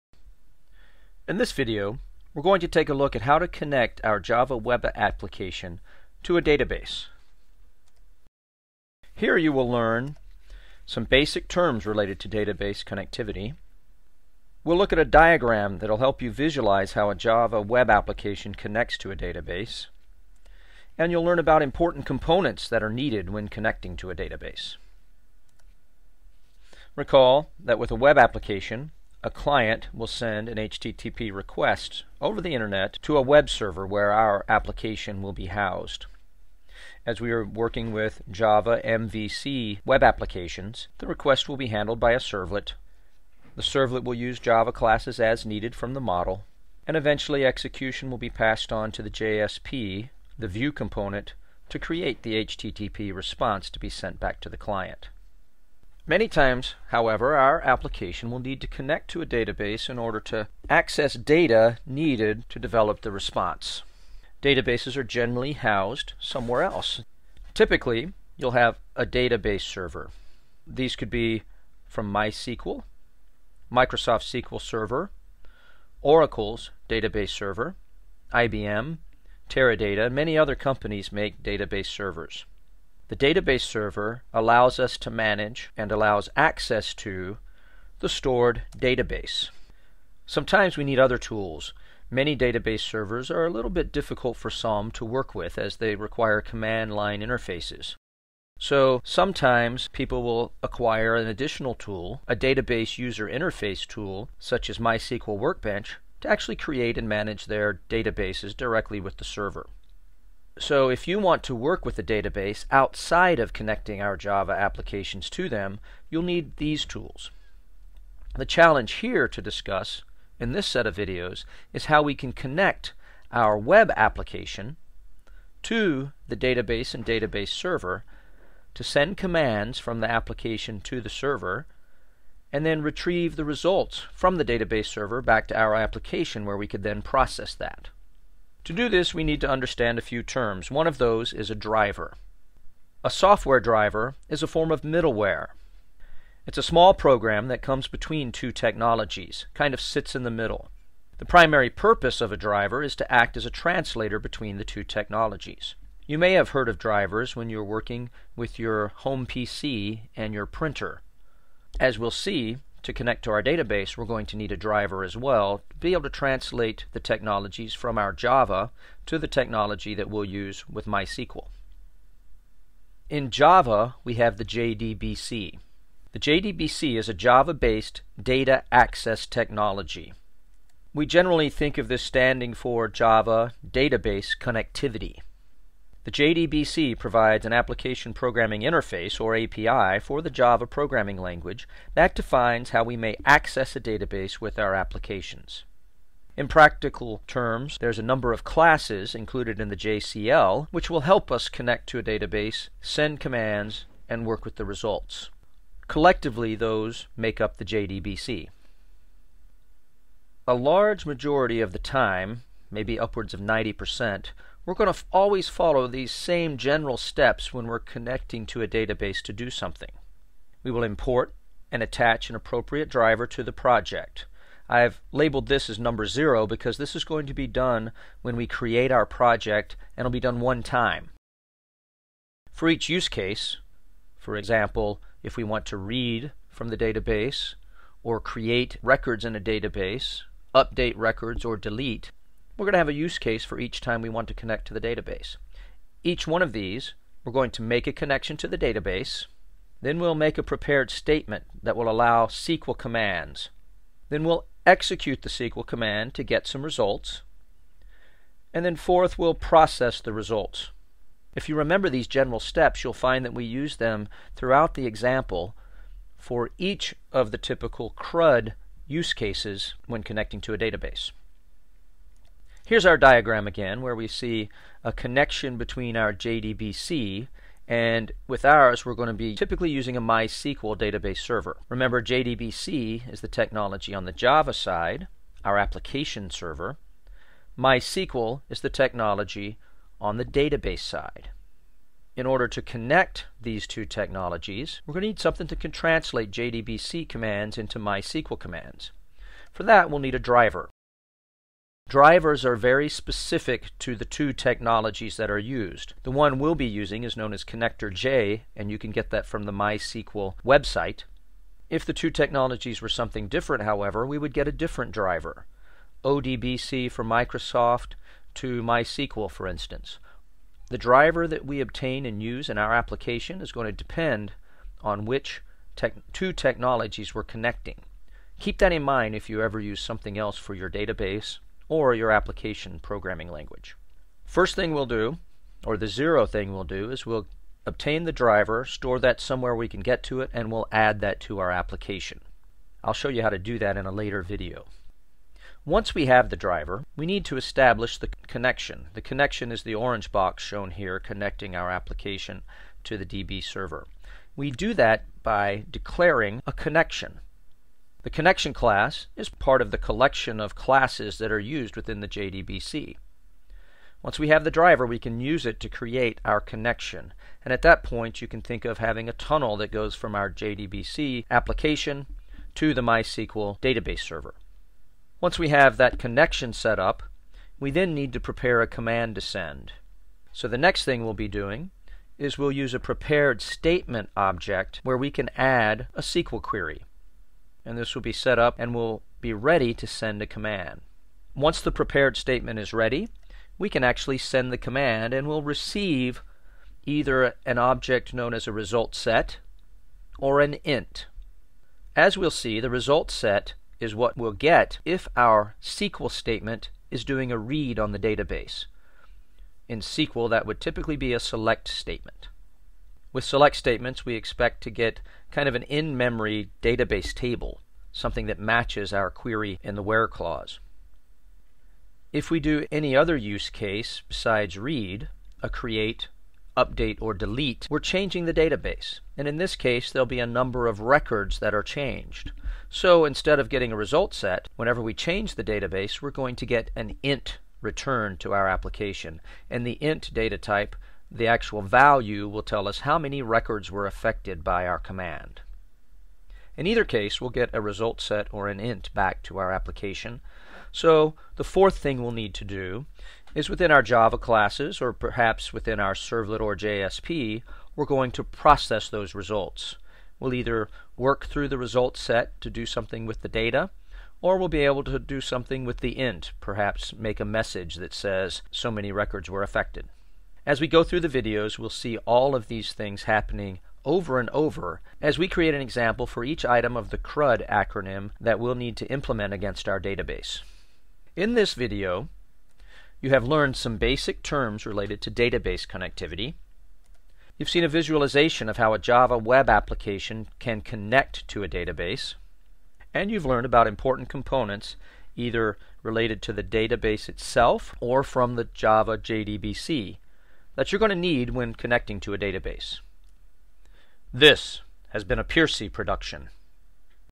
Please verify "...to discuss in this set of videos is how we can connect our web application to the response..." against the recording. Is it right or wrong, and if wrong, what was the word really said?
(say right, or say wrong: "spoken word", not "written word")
wrong: "database", not "response".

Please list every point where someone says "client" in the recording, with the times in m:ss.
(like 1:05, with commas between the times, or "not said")
0:29, 0:54.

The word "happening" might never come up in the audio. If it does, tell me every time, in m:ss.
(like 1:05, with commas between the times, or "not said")
7:53.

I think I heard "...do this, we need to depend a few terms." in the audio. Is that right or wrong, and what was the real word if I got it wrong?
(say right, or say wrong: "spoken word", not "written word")
wrong: "understand", not "depend".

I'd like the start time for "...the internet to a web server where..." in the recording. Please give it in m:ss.
0:32.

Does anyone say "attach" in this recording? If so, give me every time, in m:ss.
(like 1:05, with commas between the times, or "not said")
3:41.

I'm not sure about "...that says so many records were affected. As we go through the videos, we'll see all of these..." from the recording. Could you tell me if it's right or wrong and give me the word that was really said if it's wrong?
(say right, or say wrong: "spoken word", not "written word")
right.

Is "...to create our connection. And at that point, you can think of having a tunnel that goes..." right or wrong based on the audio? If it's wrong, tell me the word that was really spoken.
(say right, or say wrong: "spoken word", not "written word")
right.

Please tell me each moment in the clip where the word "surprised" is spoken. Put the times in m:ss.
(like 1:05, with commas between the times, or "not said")
not said.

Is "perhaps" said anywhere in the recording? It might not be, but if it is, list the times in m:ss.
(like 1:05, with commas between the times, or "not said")
7:34, 7:46.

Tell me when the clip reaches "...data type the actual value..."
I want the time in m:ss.
7:20.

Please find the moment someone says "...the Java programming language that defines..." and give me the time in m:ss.
3:10.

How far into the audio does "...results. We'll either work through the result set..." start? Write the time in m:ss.
7:39.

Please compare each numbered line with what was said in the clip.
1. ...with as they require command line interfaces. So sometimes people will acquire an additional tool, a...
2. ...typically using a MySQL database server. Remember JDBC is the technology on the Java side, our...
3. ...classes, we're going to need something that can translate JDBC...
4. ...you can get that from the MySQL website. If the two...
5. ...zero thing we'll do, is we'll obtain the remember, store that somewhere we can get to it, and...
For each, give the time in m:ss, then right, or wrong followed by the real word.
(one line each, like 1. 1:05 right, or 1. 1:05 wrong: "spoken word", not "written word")
1. 1:35 right
2. 4:39 right
3. 4:53 wrong: "technologies", not "classes"
4. 5:08 right
5. 5:35 wrong: "driver", not "remember".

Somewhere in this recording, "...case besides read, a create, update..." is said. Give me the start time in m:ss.
7:03.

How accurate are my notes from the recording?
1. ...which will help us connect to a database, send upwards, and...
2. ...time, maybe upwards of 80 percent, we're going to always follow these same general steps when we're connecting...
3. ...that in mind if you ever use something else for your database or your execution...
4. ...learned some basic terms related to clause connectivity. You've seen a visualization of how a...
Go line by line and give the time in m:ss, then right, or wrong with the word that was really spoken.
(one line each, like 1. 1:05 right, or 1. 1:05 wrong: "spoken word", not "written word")
1. 3:20 wrong: "commands", not "upwards"
2. 3:31 wrong: "90", not "80"
3. 5:28 wrong: "application", not "execution"
4. 8:03 wrong: "database", not "clause".